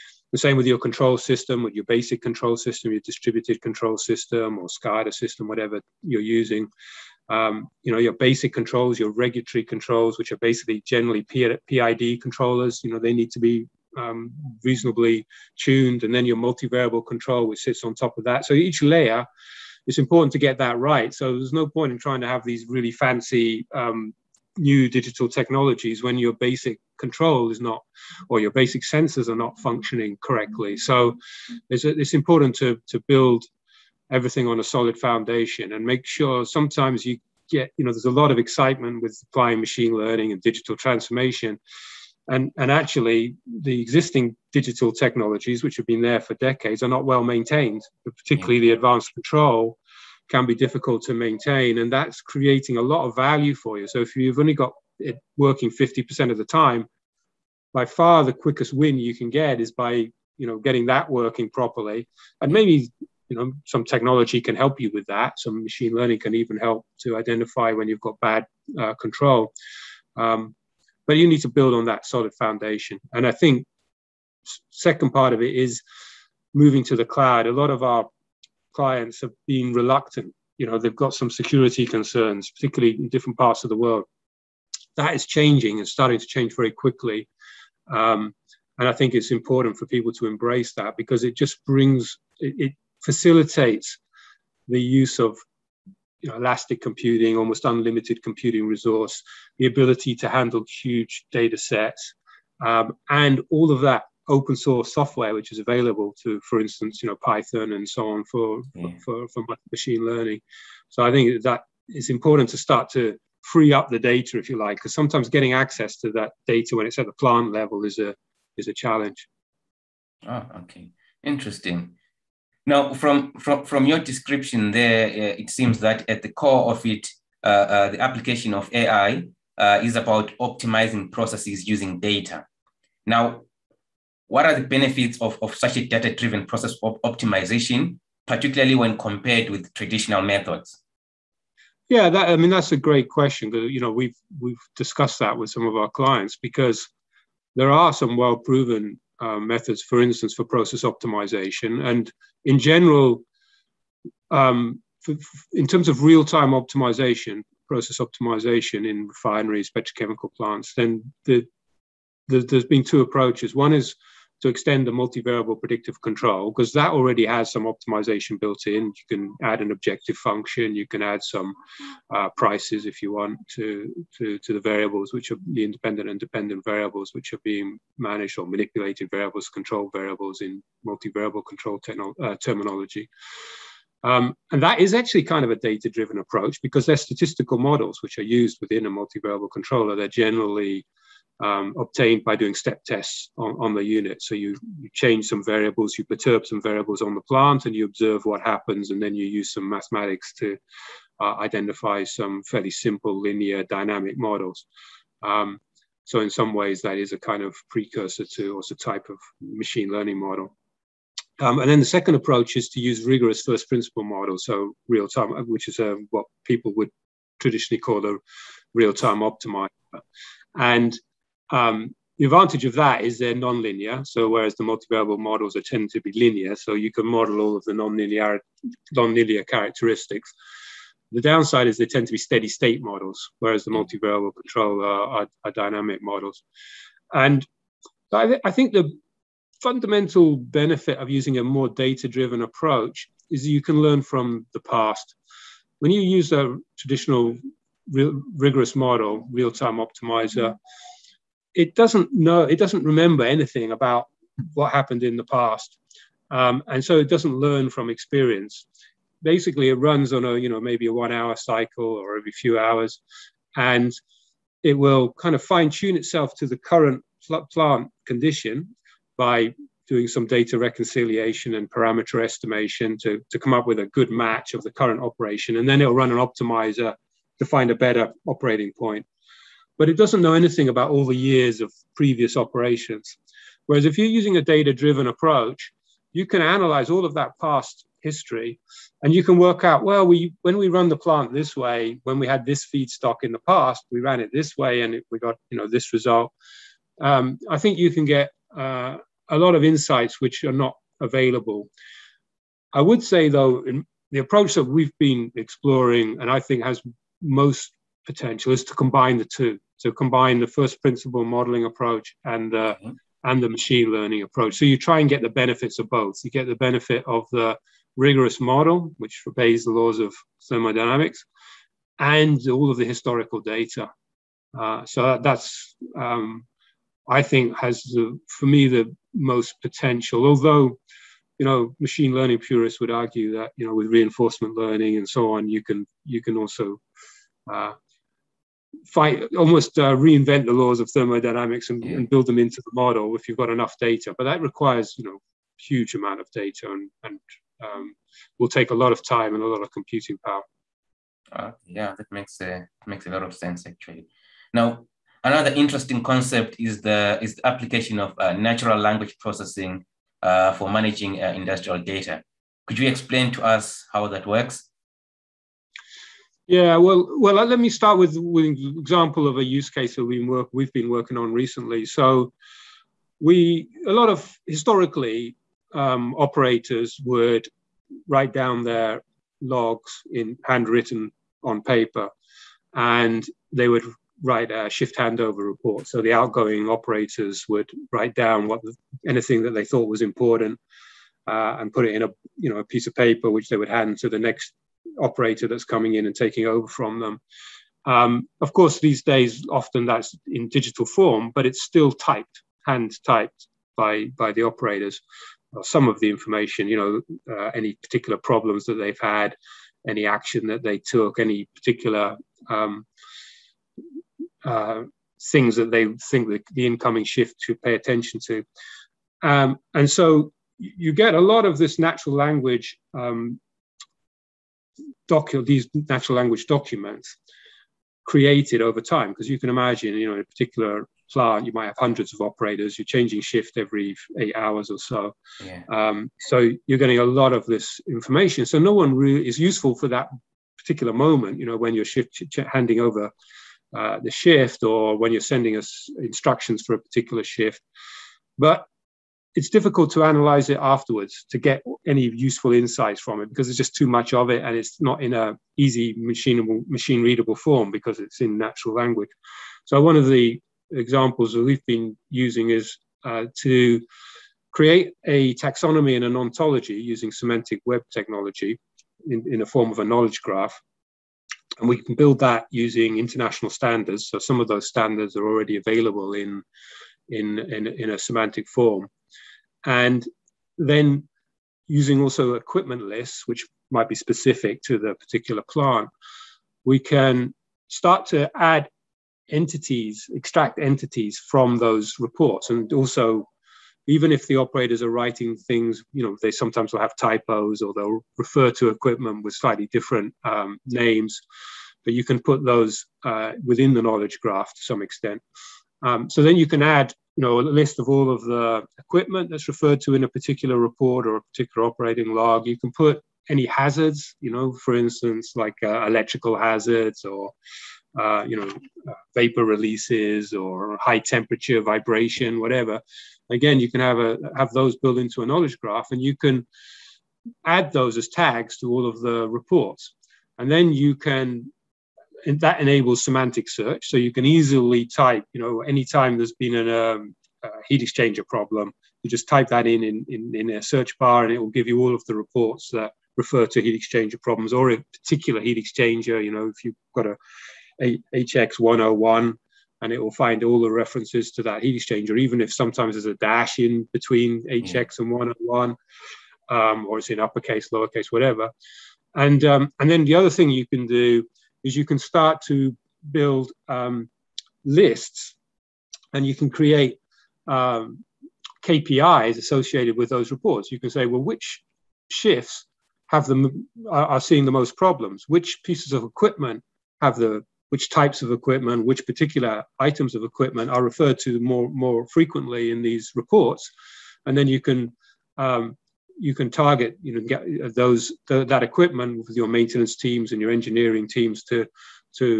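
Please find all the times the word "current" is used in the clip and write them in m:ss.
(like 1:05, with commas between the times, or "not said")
4:26, 4:34.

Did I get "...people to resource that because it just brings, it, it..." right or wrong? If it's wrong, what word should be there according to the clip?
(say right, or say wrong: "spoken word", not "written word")
wrong: "embrace", not "resource".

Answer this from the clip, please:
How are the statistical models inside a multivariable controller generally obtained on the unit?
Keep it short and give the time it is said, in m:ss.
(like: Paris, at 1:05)
step tests, at 3:12.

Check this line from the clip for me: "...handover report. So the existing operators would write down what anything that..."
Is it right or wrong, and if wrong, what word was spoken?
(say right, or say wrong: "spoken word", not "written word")
wrong: "outgoing", not "existing".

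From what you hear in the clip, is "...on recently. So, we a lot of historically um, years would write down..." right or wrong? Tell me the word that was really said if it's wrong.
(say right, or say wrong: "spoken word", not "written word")
wrong: "operators", not "years".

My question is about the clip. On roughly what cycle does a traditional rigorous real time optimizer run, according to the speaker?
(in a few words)
one hour.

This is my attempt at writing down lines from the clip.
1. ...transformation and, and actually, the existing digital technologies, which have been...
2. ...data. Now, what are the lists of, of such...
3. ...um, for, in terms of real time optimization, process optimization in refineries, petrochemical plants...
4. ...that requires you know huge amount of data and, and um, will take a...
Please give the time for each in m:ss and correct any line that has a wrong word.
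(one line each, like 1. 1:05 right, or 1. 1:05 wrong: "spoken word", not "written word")
1. 0:40 right
2. 2:11 wrong: "benefits", not "lists"
3. 2:34 right
4. 5:44 right.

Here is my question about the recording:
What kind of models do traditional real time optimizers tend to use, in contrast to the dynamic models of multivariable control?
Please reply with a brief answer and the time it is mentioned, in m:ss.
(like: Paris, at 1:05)
steady state models, at 3:52.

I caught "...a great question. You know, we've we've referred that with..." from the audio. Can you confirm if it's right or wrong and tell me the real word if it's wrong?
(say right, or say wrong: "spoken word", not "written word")
wrong: "discussed", not "referred".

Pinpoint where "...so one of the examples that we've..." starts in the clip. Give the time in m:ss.
7:39.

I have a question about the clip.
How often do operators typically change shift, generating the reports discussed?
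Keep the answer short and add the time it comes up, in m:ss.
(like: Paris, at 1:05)
every 8 hours, at 7:13.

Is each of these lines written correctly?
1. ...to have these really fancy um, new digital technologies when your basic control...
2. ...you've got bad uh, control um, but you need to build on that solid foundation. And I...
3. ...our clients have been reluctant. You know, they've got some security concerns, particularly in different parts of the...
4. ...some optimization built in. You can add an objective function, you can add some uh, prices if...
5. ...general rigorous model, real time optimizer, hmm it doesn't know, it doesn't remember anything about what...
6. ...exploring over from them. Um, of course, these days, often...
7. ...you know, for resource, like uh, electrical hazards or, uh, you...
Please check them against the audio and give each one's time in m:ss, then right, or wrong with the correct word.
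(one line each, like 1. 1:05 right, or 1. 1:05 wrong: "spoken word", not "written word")
1. 0:22 right
2. 1:07 right
3. 1:17 right
4. 2:47 right
5. 4:06 wrong: "traditional", not "general"
6. 6:36 wrong: "taking", not "exploring"
7. 8:34 wrong: "instance", not "resource".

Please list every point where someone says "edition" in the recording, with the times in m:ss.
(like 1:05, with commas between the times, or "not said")
not said.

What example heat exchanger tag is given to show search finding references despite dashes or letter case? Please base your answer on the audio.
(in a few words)
HX101.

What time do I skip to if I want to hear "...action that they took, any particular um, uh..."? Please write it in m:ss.
6:50.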